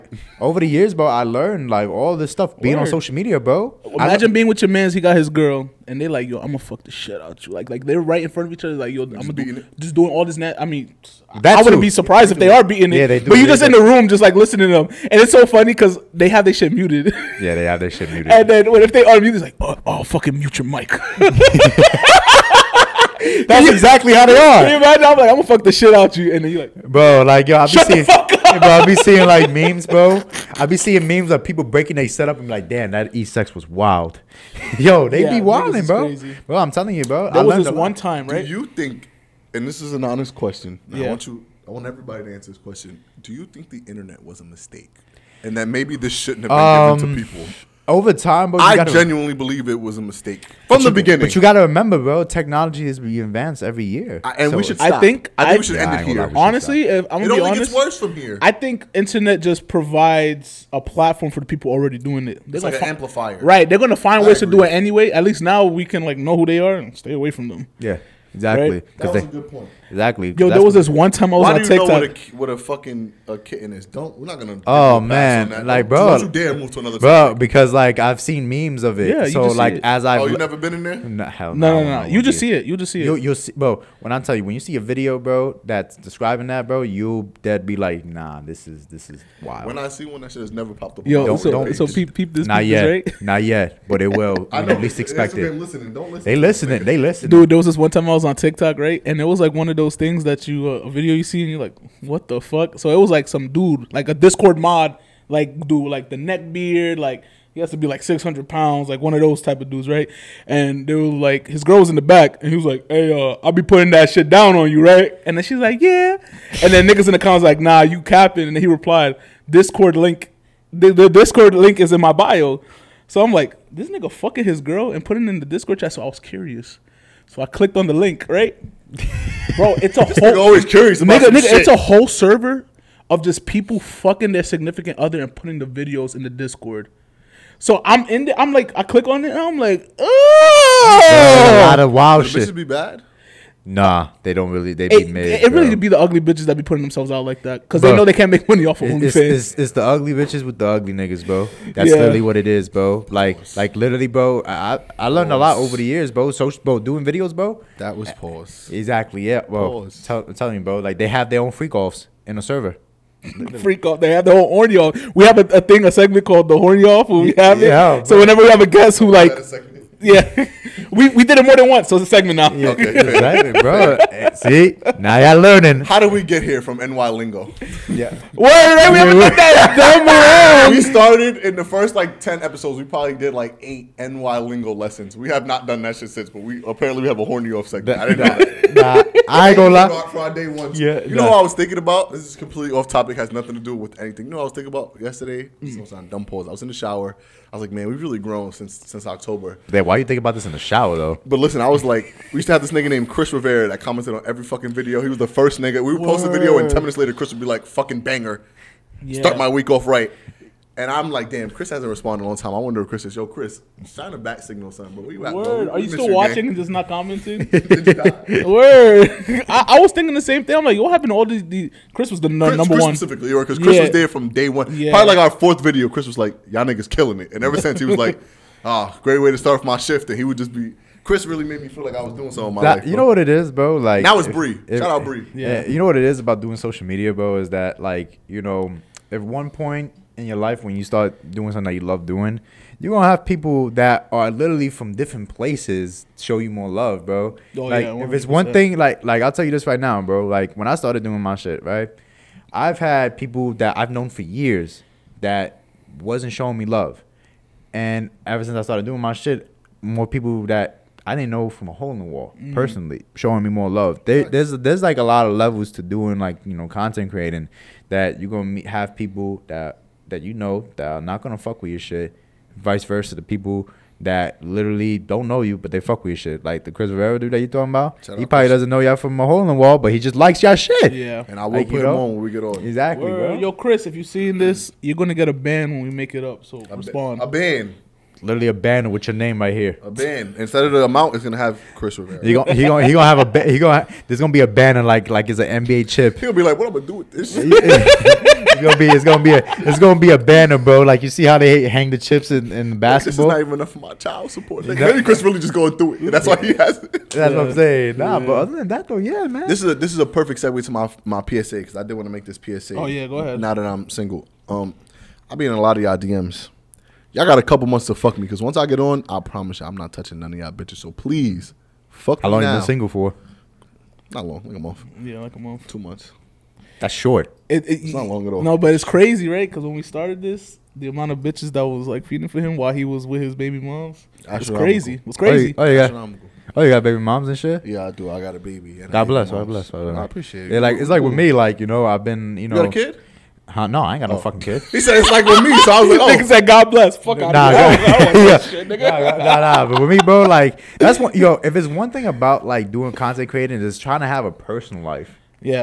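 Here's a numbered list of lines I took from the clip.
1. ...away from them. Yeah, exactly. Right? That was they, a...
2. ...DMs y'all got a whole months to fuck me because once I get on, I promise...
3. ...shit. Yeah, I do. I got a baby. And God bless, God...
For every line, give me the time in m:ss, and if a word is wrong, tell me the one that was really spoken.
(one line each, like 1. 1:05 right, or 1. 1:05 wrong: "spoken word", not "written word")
1. 1:07 right
2. 5:15 wrong: "couple", not "whole"
3. 5:37 right.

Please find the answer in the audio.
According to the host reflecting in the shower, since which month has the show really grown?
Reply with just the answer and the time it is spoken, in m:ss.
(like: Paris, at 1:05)
October, at 3:19.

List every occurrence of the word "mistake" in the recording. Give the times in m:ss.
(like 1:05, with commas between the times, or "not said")
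0:44, 0:50.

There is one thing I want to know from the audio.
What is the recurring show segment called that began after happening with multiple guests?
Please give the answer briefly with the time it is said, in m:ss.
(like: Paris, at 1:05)
The horny off, at 2:46.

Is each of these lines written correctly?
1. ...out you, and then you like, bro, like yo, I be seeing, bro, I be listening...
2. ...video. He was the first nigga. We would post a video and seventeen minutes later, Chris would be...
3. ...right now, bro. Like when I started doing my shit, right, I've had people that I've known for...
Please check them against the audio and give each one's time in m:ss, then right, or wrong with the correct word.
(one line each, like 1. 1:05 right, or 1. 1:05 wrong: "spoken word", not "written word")
1. 0:25 wrong: "seeing", not "listening"
2. 3:24 wrong: "ten", not "seventeen"
3. 4:09 right.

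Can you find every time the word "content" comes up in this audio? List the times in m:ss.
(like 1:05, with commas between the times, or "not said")
4:26, 5:52.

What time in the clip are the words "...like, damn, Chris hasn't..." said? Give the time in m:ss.
3:31.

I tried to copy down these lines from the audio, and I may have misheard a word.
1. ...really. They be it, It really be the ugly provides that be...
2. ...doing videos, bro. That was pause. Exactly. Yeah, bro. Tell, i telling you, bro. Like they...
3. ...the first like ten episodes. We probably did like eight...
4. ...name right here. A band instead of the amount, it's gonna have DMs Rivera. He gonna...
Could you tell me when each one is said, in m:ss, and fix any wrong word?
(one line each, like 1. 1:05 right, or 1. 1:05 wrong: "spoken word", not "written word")
1. 2:24 wrong: "bitches", not "provides"
2. 2:36 right
3. 3:01 right
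4. 4:49 wrong: "Chris", not "DMs".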